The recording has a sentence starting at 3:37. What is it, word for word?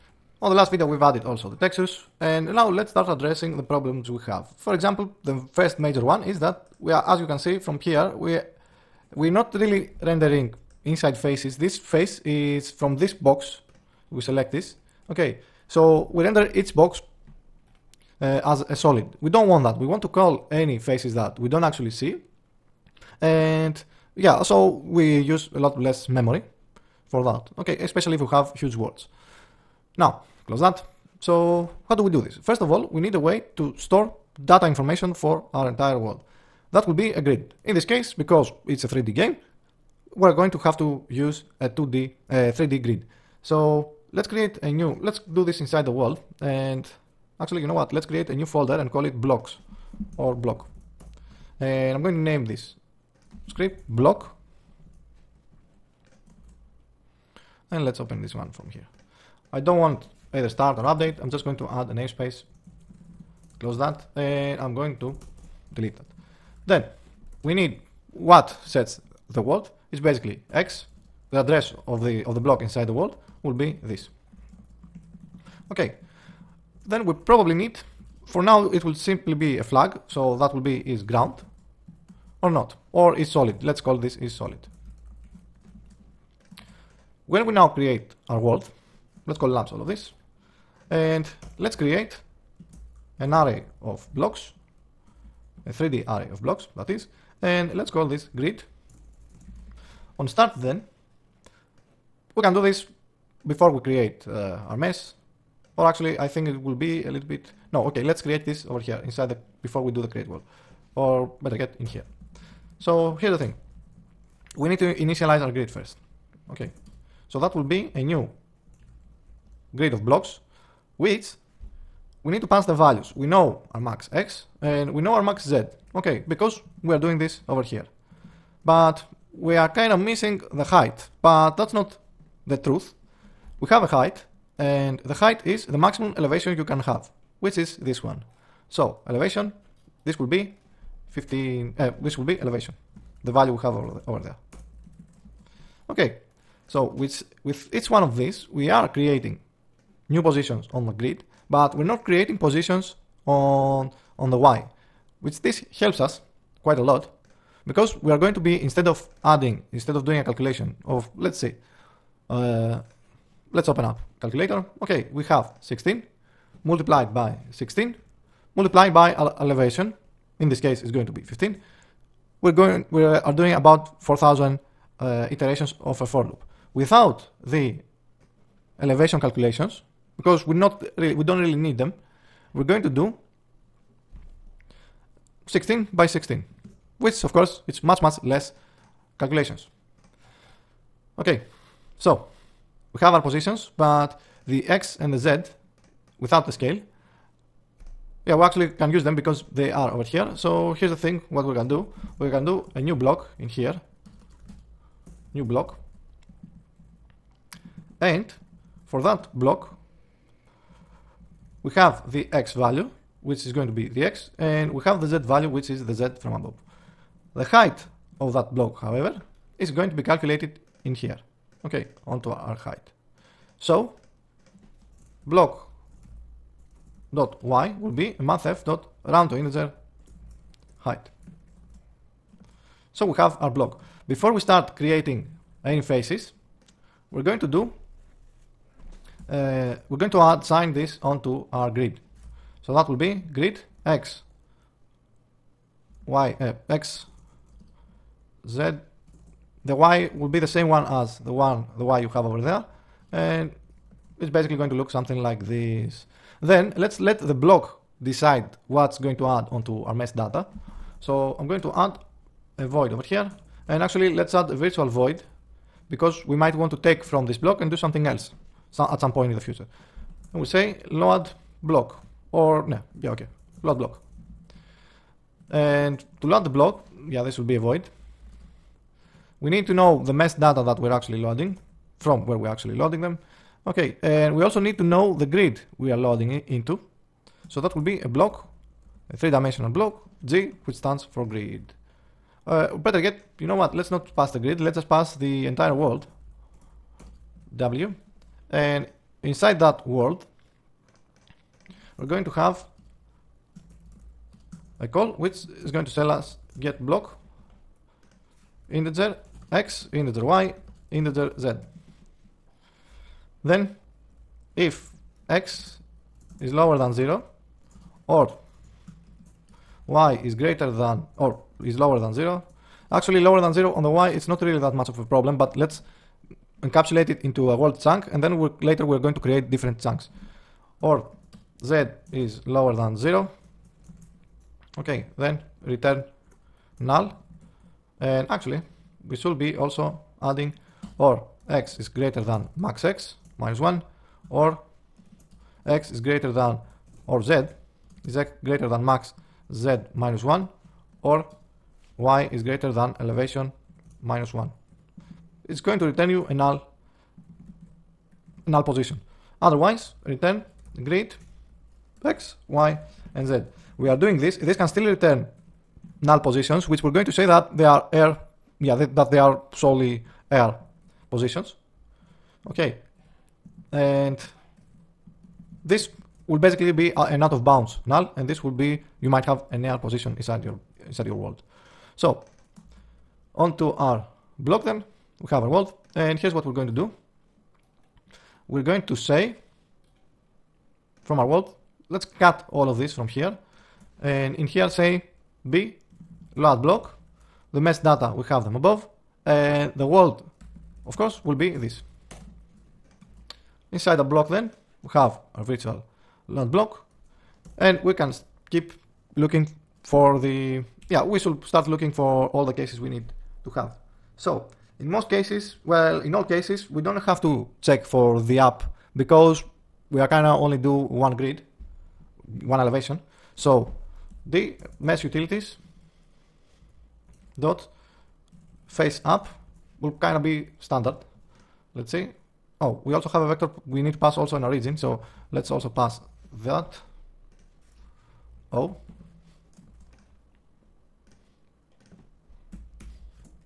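The height of that block, however, is going to be calculated in here.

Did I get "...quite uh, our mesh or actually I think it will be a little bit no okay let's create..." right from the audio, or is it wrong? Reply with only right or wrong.
wrong.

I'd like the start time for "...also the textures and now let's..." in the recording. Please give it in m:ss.
0:01.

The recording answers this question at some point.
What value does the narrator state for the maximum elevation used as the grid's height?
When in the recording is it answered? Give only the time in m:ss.
2:20.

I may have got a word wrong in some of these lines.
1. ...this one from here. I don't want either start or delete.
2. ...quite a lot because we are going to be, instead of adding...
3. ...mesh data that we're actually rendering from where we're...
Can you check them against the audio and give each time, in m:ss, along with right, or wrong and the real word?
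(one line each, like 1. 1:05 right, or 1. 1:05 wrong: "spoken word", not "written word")
1. 0:58 wrong: "update", not "delete"
2. 2:36 right
3. 4:40 wrong: "loading", not "rendering".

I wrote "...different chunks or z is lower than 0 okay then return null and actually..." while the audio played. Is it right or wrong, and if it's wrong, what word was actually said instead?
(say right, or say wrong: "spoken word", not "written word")
right.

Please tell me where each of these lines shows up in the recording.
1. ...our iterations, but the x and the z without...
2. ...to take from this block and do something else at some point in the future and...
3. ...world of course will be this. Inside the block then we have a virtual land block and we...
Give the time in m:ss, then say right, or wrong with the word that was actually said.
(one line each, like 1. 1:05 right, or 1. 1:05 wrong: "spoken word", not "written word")
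1. 3:13 wrong: "positions", not "iterations"
2. 4:26 right
3. 6:39 right.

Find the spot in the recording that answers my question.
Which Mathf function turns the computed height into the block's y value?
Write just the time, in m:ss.
3:48.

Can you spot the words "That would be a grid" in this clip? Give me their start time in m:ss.
0:36.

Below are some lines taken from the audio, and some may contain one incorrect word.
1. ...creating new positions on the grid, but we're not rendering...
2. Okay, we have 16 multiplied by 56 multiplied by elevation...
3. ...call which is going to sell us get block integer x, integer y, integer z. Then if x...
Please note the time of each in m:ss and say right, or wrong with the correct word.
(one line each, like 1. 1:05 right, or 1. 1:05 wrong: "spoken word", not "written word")
1. 2:28 wrong: "creating", not "rendering"
2. 2:44 wrong: "16", not "56"
3. 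5:04 right.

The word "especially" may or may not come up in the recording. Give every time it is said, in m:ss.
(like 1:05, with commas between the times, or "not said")
0:27.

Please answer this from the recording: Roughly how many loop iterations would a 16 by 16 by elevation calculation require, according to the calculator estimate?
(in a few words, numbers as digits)
about 4000.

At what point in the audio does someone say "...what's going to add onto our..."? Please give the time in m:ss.
4:18.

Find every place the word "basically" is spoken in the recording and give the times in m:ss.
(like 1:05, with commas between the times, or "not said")
1:09, 4:14, 6:16.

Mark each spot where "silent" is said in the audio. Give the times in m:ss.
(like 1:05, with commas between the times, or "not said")
not said.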